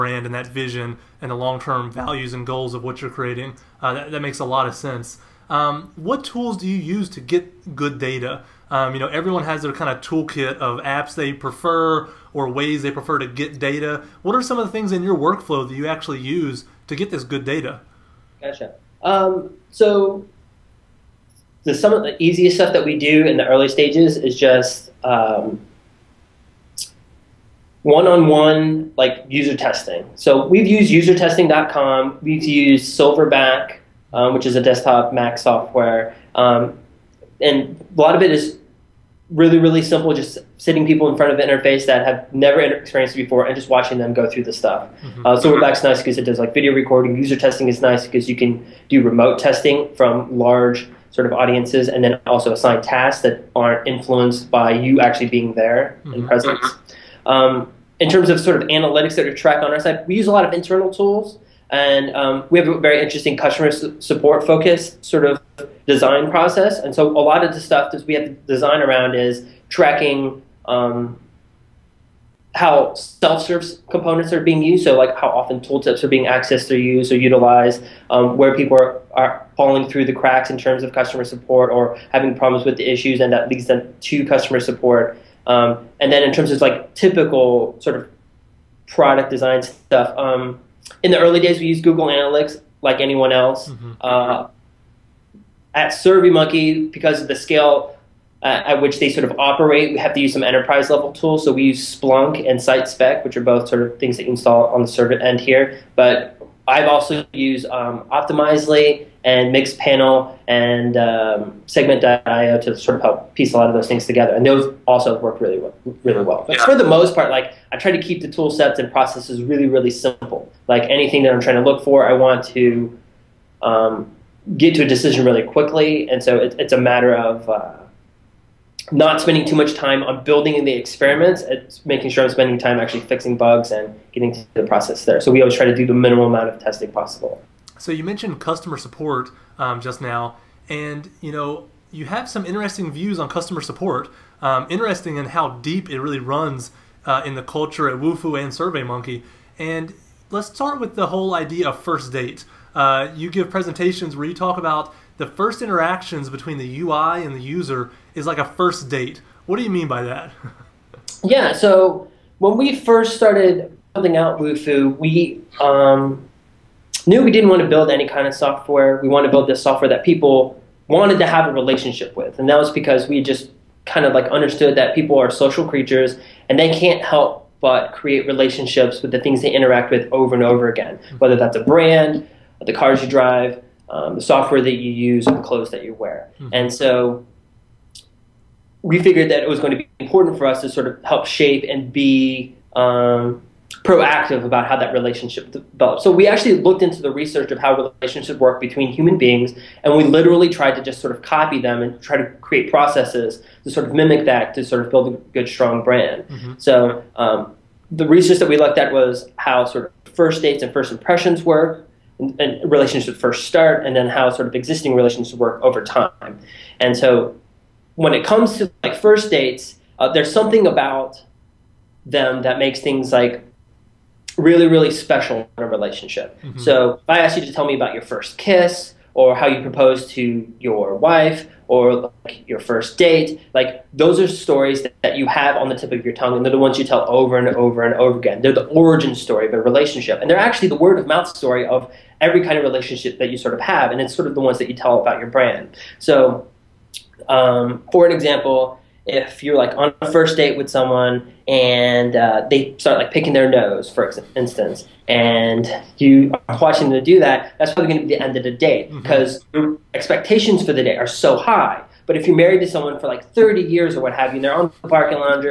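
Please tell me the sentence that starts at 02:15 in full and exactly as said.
So we always try to do the minimal amount of testing possible.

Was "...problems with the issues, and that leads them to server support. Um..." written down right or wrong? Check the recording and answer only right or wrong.
wrong.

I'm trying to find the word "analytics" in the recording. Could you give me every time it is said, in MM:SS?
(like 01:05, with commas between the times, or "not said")
00:58, 01:32.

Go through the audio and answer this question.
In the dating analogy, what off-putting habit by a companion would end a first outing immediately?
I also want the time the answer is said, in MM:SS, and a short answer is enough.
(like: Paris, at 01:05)
picking their nose, at 04:13.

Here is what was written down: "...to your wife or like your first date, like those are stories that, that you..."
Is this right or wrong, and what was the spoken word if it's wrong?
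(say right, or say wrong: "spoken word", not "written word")
right.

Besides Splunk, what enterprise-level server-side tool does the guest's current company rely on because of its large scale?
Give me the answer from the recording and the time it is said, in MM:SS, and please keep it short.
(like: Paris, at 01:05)
SiteSpect, at 01:42.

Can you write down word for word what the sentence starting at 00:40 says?
Just sitting people in front of an interface that have never experienced it before and just watching them go through the stuff.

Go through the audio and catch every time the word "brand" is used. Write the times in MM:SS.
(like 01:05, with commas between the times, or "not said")
03:01, 03:25, 04:05.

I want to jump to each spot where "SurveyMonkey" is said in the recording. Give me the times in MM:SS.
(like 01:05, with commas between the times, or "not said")
01:35, 02:28.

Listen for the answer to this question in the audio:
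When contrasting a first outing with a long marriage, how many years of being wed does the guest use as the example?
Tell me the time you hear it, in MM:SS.
04:23.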